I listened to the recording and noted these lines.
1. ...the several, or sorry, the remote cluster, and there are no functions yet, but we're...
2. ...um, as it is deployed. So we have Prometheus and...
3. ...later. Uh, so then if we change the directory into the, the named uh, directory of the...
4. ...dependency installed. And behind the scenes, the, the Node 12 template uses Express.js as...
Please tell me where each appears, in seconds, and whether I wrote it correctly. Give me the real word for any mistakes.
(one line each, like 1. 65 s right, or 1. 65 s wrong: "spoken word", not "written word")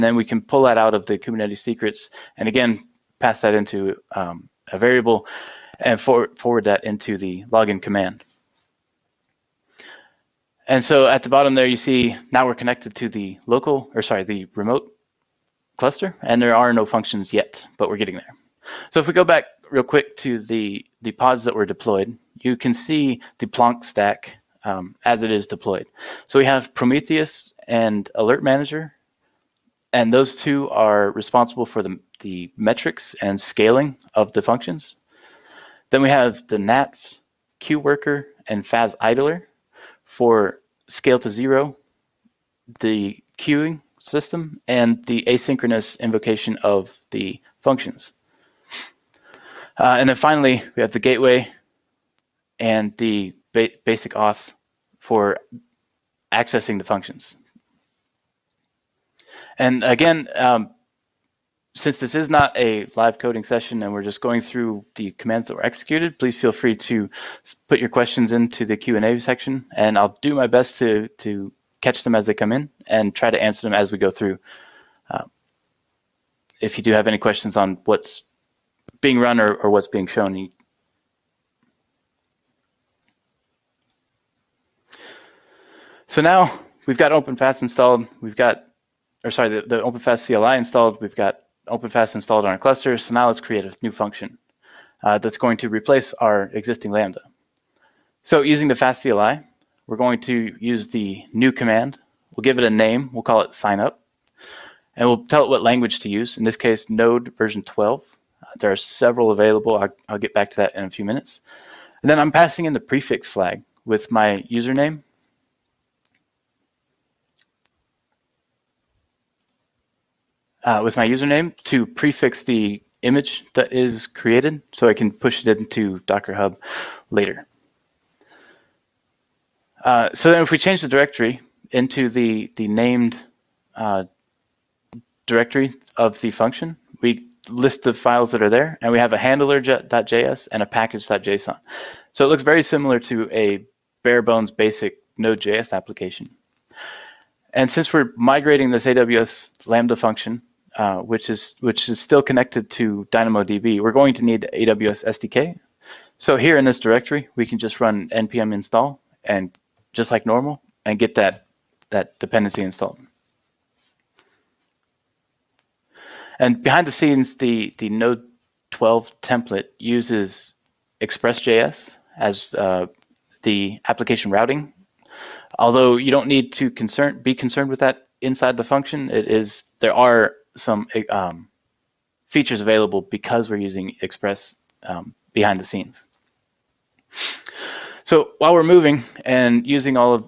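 1. 13 s wrong: "local", not "several"
2. 24 s right
3. 127 s right
4. 162 s right.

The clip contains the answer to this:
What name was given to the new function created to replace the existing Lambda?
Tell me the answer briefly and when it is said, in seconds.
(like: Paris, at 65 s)
sign up, at 103 s.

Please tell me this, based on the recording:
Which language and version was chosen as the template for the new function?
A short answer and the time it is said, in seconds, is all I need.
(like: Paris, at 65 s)
Node version 12, at 106 s.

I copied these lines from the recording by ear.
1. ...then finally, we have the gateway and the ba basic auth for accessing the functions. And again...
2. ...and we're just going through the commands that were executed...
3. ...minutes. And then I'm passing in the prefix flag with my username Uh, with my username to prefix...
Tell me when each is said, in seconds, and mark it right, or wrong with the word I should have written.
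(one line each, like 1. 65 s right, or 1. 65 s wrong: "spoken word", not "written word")
1. 50 s right
2. 63 s right
3. 111 s right.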